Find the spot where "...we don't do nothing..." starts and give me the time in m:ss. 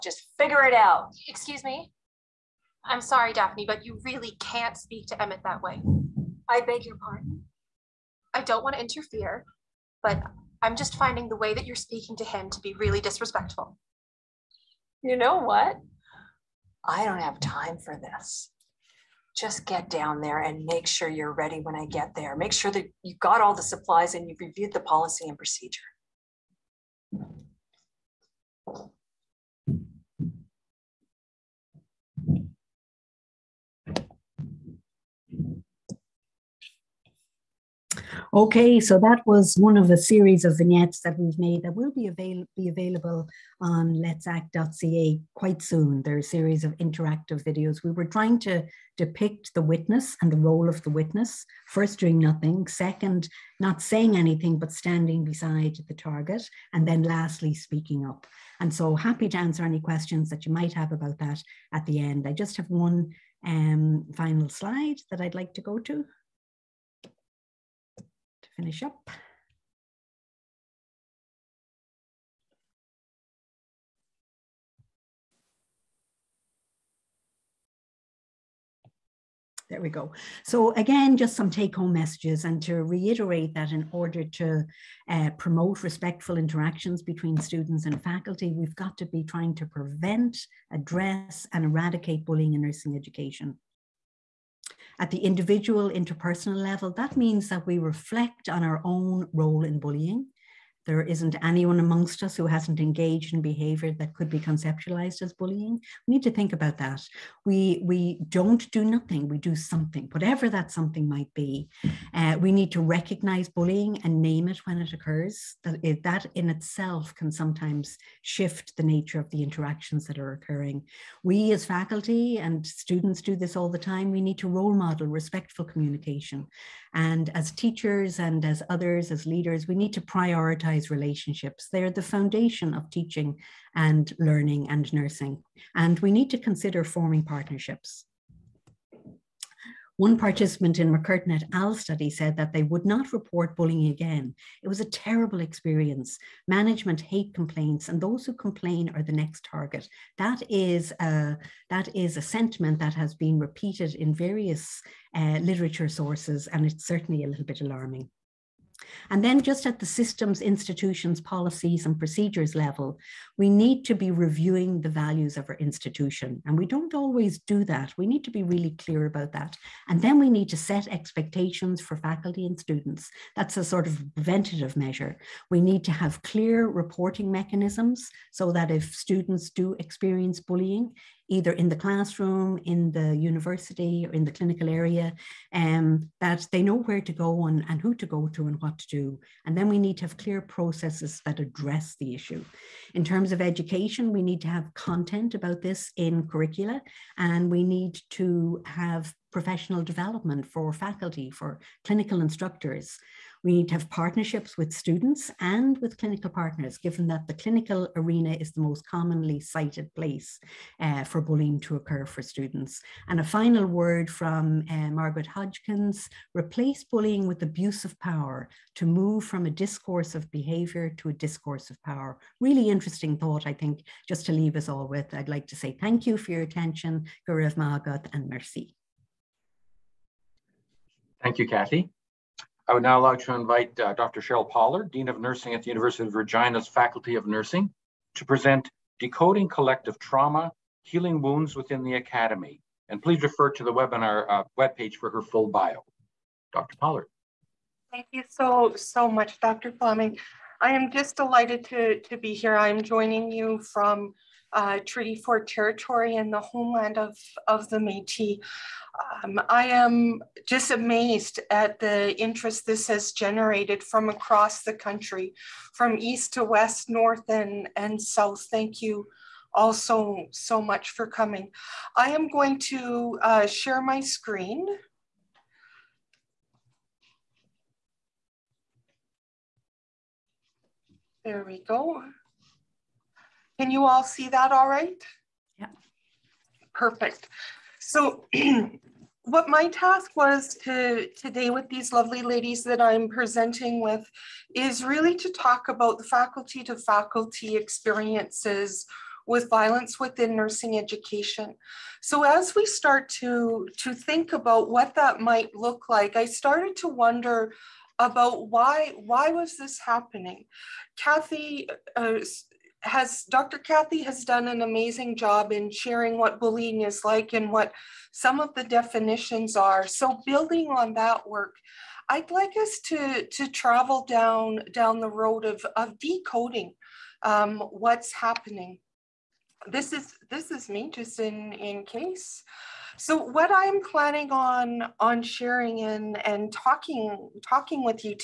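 1:47.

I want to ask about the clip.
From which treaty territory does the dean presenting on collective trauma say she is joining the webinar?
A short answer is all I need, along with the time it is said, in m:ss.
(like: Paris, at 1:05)
Treaty 4, at 4:14.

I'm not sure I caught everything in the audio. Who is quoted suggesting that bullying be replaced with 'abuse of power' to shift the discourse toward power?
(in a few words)
Margaret Hodgins.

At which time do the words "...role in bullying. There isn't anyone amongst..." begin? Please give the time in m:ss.
1:39.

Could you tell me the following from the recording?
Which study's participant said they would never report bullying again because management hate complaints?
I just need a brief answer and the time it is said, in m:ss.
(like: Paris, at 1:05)
McCurtain et al., at 2:20.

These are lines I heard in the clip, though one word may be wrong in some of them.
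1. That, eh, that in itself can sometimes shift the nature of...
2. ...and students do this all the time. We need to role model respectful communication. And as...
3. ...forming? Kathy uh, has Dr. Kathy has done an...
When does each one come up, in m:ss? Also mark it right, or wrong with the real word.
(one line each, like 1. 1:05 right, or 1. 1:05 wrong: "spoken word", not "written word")
1. 1:55 right
2. 2:02 right
3. 5:09 wrong: "happening", not "forming".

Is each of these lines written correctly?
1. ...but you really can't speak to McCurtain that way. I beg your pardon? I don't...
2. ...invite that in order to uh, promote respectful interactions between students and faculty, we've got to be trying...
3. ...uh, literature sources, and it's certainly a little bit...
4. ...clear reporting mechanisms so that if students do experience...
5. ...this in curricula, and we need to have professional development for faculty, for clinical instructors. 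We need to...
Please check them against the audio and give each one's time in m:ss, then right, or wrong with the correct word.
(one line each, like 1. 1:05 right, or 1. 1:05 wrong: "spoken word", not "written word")
1. 0:03 wrong: "Emmett", not "McCurtain"
2. 1:22 wrong: "reiterate", not "invite"
3. 2:35 right
4. 2:56 right
5. 3:15 right.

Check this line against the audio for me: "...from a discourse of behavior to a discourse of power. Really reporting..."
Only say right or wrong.
wrong.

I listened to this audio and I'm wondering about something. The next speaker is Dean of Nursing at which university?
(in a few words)
University of Regina.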